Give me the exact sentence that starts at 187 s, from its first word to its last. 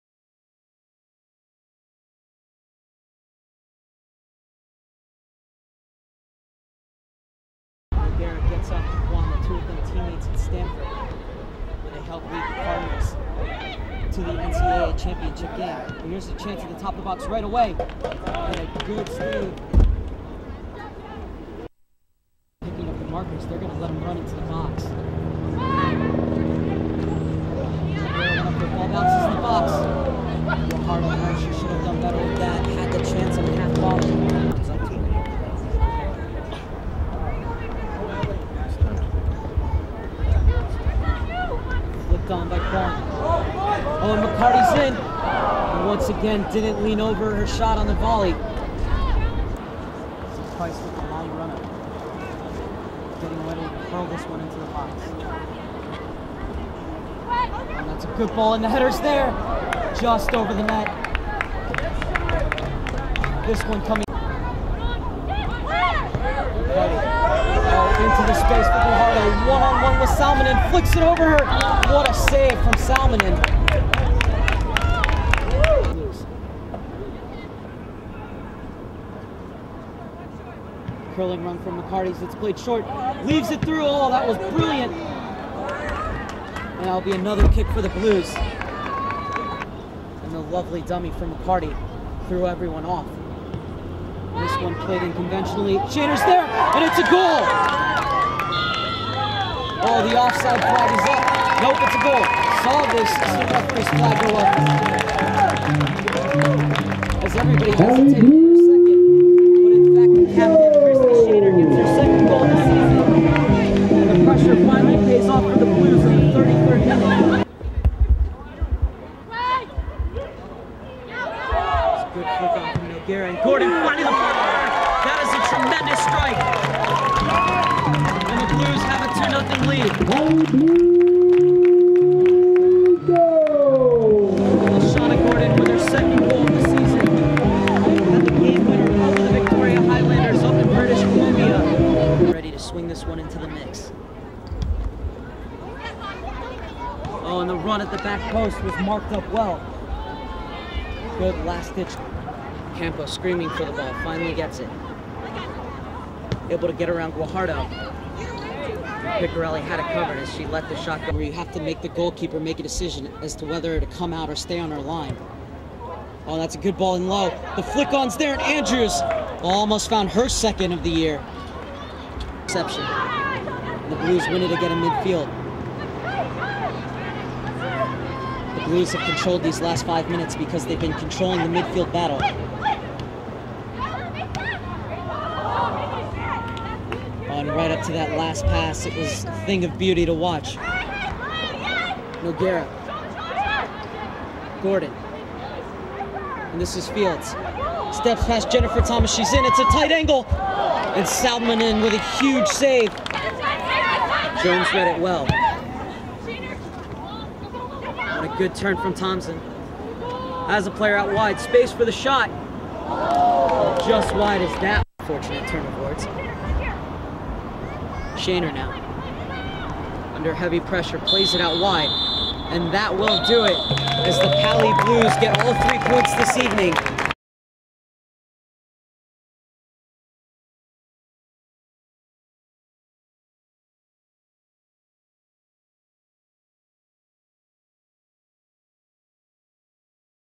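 right up to that last pass, it was a thing of beauty to watch.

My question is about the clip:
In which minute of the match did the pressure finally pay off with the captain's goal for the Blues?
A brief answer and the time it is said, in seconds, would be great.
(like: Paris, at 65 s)
33rd, at 116 s.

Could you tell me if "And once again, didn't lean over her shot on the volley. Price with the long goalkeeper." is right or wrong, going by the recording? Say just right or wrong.
wrong.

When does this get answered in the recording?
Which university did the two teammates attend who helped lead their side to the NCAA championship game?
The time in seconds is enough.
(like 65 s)
10 s.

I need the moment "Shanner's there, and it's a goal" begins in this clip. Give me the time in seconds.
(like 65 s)
95 s.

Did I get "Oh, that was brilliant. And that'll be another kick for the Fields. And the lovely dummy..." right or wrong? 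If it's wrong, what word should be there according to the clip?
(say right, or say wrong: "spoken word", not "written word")
wrong: "Blues", not "Fields".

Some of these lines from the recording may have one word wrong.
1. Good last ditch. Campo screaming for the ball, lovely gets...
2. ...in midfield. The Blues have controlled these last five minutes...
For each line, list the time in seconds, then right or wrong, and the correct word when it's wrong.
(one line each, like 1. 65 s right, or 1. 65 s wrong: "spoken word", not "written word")
1. 151 s wrong: "finally", not "lovely"
2. 174 s right.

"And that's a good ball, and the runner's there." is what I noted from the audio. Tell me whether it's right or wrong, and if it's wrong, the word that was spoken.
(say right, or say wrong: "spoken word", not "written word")
wrong: "header", not "runner".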